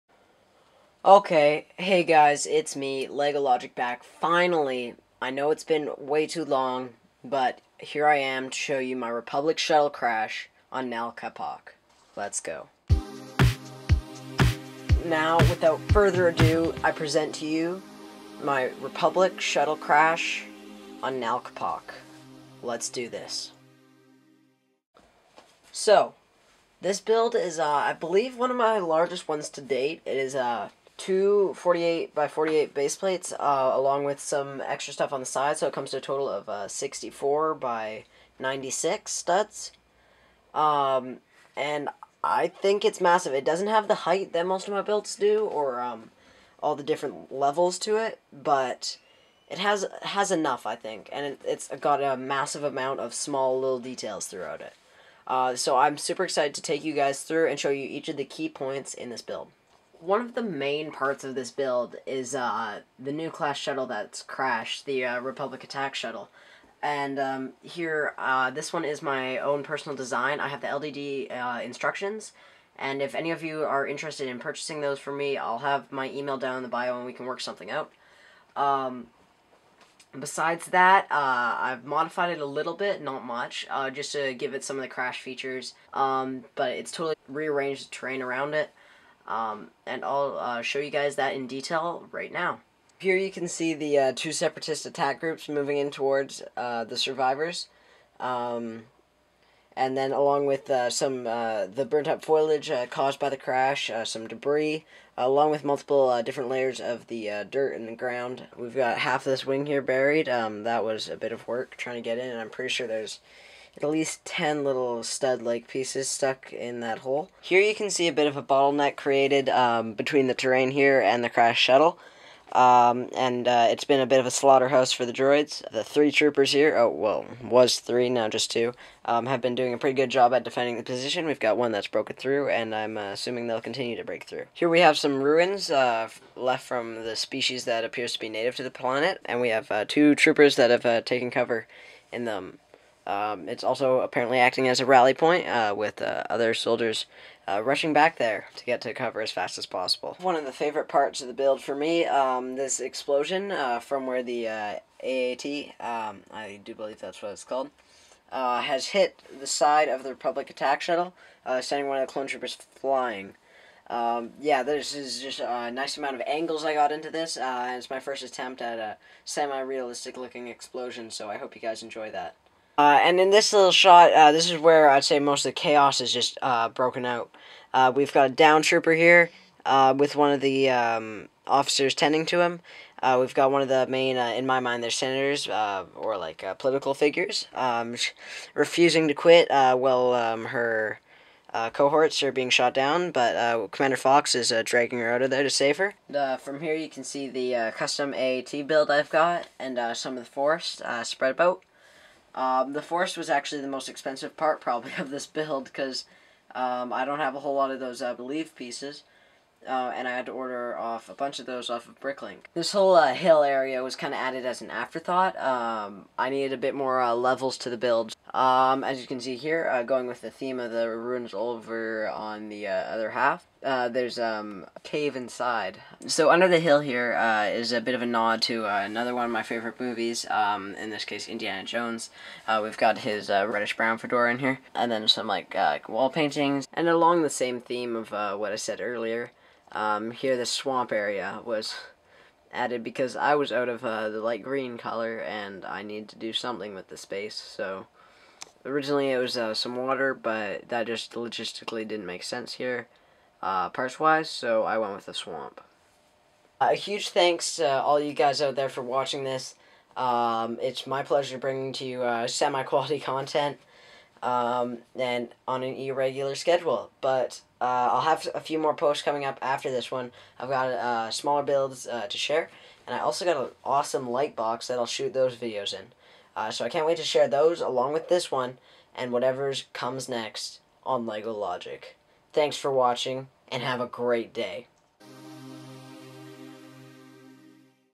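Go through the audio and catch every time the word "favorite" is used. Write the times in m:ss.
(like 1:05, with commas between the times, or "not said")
2:30, 3:49.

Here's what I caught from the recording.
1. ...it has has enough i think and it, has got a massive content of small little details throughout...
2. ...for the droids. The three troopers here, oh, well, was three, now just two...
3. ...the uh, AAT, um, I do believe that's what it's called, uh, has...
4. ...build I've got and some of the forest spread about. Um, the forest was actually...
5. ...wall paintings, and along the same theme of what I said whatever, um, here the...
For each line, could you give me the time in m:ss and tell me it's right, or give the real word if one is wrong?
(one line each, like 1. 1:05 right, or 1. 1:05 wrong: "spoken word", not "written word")
1. 0:49 wrong: "amount", not "content"
2. 2:04 right
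3. 2:34 right
4. 3:18 right
5. 3:55 wrong: "earlier", not "whatever".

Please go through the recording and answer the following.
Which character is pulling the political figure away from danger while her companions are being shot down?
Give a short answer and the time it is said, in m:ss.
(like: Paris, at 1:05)
Commander Fox, at 3:13.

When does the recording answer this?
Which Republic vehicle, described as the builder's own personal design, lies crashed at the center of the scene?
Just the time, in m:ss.
1:03.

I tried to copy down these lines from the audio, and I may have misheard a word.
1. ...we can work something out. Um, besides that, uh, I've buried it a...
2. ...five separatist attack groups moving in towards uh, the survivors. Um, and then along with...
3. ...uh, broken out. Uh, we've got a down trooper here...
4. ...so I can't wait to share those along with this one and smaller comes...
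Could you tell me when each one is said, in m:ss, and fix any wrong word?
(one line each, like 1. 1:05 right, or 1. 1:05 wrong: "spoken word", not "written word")
1. 1:17 wrong: "modified", not "buried"
2. 1:34 wrong: "two", not "five"
3. 2:56 right
4. 4:36 wrong: "whatever", not "smaller".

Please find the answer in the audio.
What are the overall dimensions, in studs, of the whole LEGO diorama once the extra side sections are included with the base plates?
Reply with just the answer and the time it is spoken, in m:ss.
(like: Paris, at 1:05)
64 by 96 studs, at 0:36.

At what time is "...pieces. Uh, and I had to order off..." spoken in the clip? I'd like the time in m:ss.
3:28.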